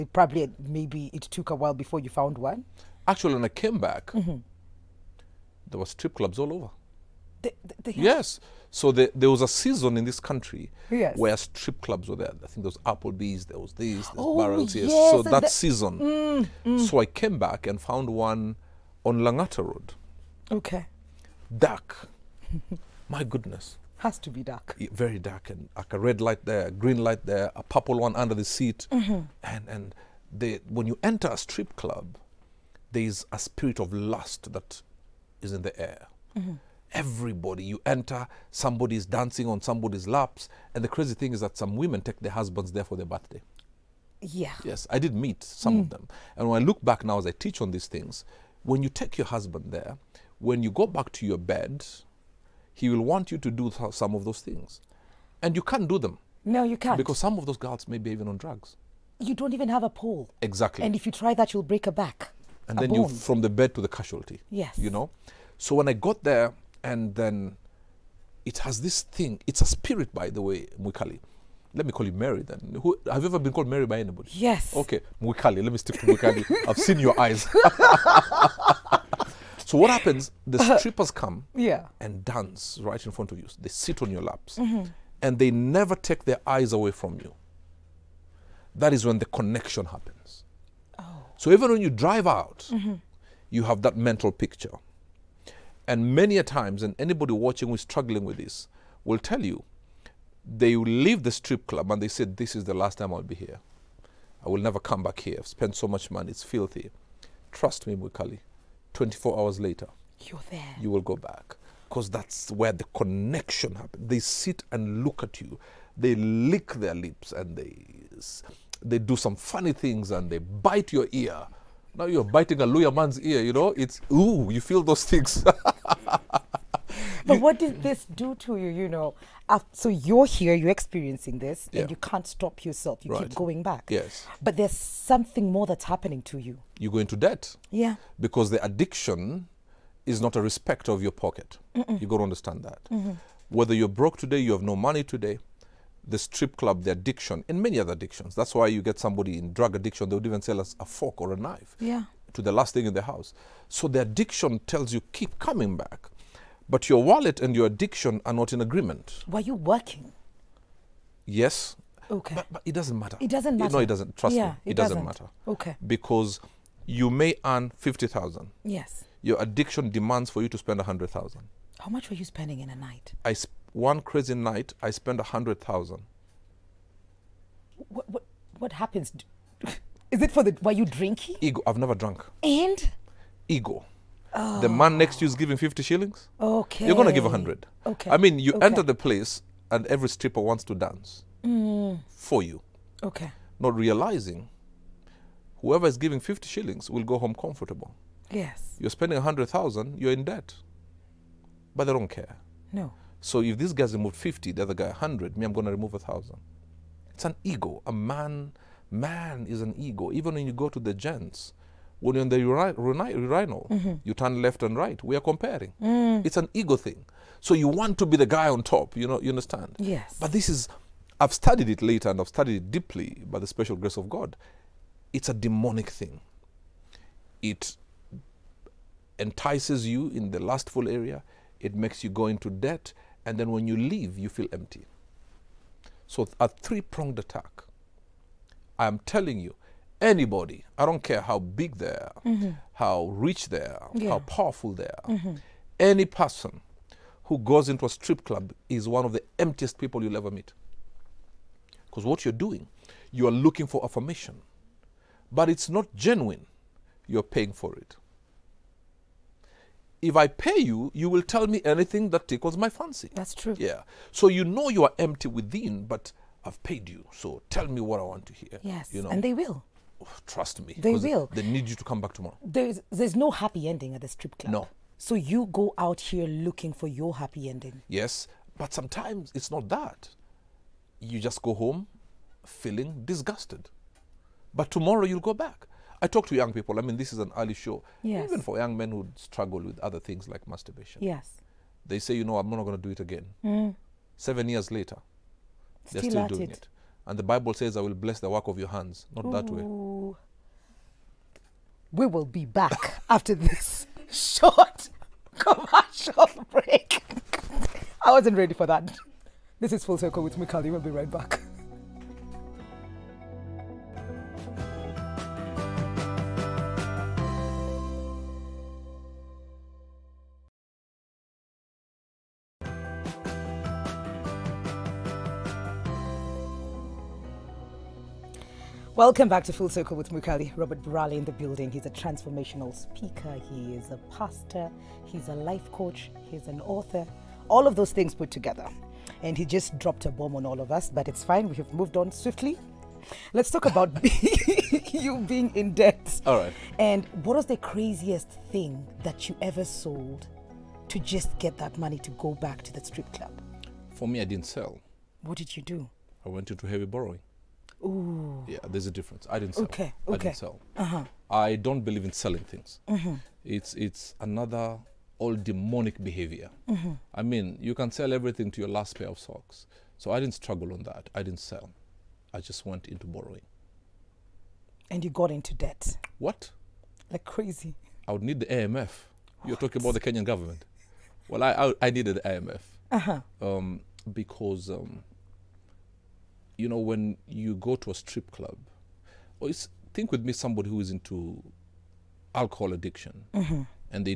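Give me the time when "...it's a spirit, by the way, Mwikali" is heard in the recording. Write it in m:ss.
1:09.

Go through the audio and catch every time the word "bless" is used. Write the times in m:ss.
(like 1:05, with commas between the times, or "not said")
4:57.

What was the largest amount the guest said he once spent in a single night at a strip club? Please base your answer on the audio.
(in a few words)
100,000.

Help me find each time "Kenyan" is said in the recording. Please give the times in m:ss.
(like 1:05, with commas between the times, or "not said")
6:19.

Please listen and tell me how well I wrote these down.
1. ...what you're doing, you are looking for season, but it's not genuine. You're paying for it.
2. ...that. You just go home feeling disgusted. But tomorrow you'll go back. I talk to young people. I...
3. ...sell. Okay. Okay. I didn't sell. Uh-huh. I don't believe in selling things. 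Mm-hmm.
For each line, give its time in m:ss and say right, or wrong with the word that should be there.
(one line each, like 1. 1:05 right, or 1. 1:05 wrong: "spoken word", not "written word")
1. 4:12 wrong: "affirmation", not "season"
2. 4:39 right
3. 5:59 right.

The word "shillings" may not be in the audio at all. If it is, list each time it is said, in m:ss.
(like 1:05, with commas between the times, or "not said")
3:05, 3:16.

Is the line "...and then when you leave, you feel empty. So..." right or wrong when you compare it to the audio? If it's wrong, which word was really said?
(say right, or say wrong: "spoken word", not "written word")
right.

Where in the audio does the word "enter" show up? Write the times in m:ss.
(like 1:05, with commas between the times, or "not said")
0:31, 0:37, 3:08.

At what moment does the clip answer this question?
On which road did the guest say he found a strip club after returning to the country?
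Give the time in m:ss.
0:19.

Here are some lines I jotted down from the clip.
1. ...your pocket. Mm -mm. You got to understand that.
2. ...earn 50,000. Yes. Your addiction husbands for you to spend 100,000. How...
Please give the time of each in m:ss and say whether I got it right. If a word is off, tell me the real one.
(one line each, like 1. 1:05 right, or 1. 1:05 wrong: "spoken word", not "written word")
1. 2:21 right
2. 2:47 wrong: "demands", not "husbands".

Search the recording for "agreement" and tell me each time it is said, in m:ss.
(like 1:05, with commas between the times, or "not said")
2:38.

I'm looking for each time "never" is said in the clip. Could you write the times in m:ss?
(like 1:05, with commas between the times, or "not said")
1:25, 1:44, 3:01.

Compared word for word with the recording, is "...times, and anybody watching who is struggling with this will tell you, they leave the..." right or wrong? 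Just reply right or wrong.
right.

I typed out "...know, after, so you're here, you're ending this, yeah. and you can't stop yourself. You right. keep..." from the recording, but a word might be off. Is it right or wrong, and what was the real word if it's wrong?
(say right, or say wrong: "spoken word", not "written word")
wrong: "experiencing", not "ending".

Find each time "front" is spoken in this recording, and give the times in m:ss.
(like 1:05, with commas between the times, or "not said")
1:23.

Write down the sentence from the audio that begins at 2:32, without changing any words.
to the last thing in the house.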